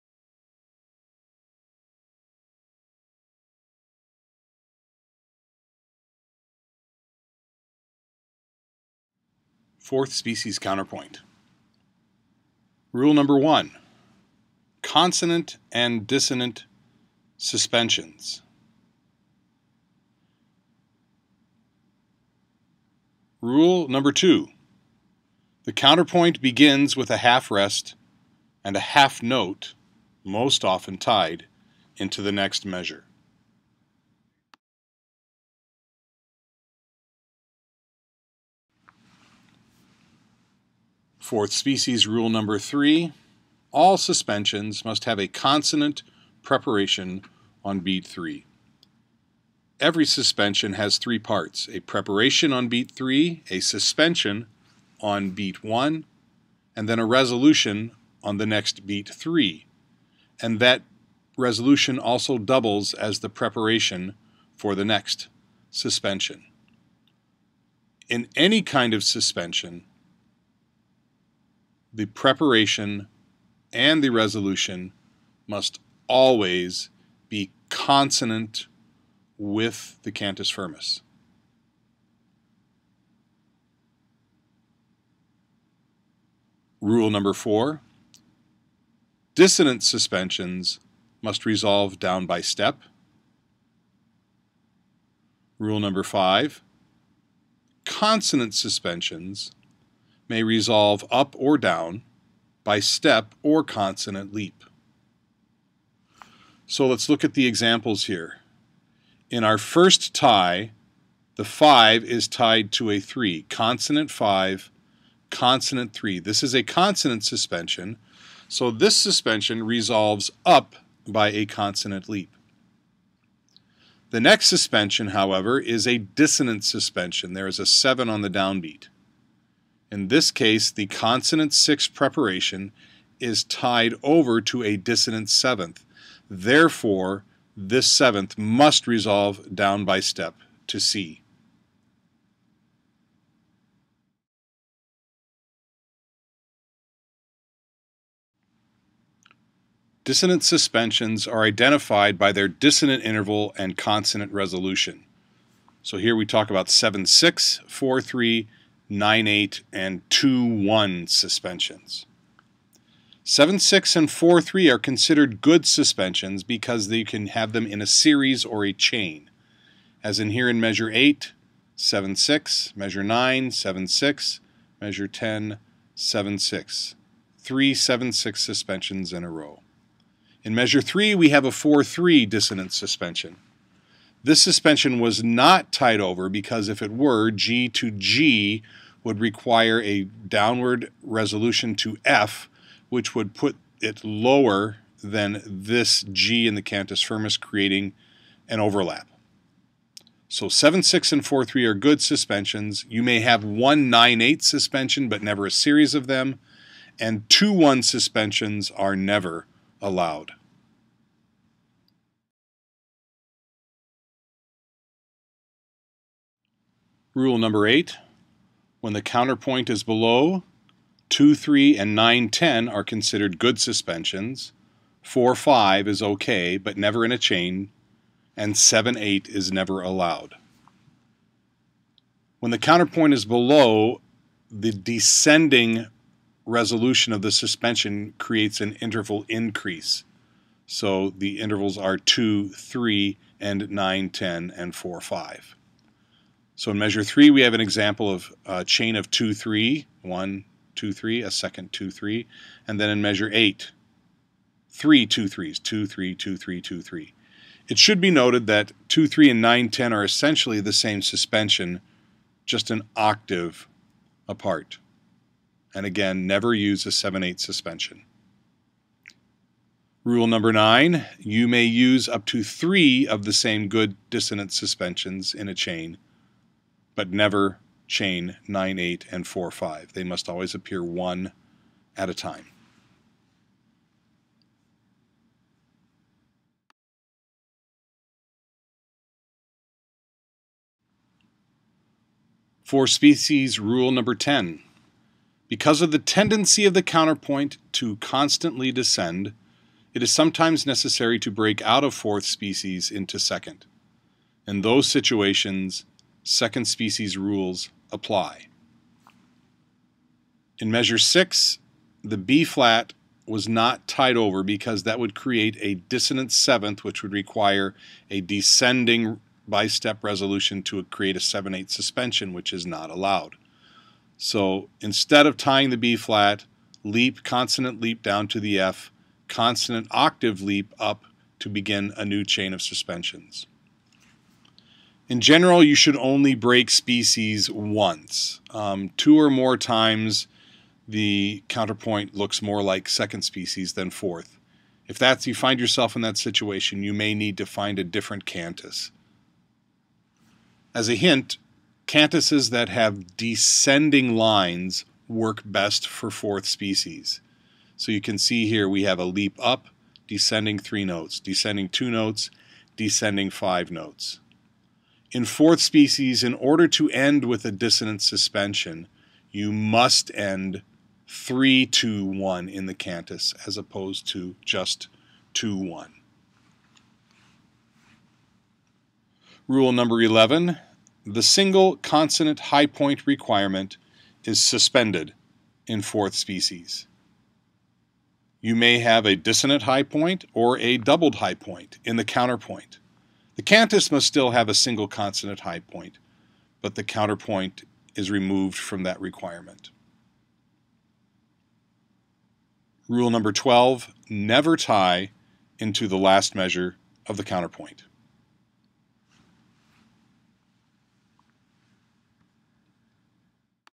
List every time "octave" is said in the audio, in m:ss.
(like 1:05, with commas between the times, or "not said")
4:22, 5:29.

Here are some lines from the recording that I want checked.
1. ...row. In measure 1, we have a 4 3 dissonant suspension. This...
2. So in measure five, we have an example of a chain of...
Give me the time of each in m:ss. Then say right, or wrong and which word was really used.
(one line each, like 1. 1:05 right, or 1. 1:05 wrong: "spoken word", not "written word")
1. 2:59 wrong: "3", not "1"
2. 4:06 wrong: "three", not "five".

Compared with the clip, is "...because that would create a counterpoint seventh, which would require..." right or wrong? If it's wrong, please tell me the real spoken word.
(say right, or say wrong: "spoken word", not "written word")
wrong: "dissonant", not "counterpoint".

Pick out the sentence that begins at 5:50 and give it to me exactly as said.
As a hint, cantuses that have descending lines work best for fourth species.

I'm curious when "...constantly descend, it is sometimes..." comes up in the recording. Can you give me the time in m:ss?
4:57.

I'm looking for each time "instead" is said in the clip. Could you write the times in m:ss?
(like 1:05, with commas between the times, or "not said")
5:24.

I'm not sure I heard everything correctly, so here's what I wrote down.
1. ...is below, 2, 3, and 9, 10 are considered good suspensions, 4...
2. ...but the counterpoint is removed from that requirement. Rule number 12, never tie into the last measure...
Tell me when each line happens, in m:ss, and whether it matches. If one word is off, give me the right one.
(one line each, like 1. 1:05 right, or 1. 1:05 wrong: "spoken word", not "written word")
1. 3:39 right
2. 6:36 right.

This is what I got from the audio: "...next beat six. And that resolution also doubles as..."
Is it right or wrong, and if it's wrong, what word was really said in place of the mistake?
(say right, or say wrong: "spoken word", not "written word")
wrong: "three", not "six".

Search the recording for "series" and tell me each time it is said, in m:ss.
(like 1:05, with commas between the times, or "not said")
2:47, 3:25.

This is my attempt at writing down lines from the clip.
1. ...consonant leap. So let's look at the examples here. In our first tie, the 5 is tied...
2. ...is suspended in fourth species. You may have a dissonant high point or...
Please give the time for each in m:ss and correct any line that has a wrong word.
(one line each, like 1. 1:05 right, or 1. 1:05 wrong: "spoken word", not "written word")
1. 1:43 right
2. 6:24 right.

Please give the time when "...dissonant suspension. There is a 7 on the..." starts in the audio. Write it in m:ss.
2:05.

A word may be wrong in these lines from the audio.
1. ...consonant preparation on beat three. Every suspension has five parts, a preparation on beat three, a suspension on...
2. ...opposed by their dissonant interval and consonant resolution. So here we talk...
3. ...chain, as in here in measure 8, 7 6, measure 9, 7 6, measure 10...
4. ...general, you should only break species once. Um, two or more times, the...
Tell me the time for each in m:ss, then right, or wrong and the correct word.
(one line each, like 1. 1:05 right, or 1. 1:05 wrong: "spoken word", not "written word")
1. 0:45 wrong: "three", not "five"
2. 2:31 wrong: "identified", not "opposed"
3. 2:48 right
4. 5:35 right.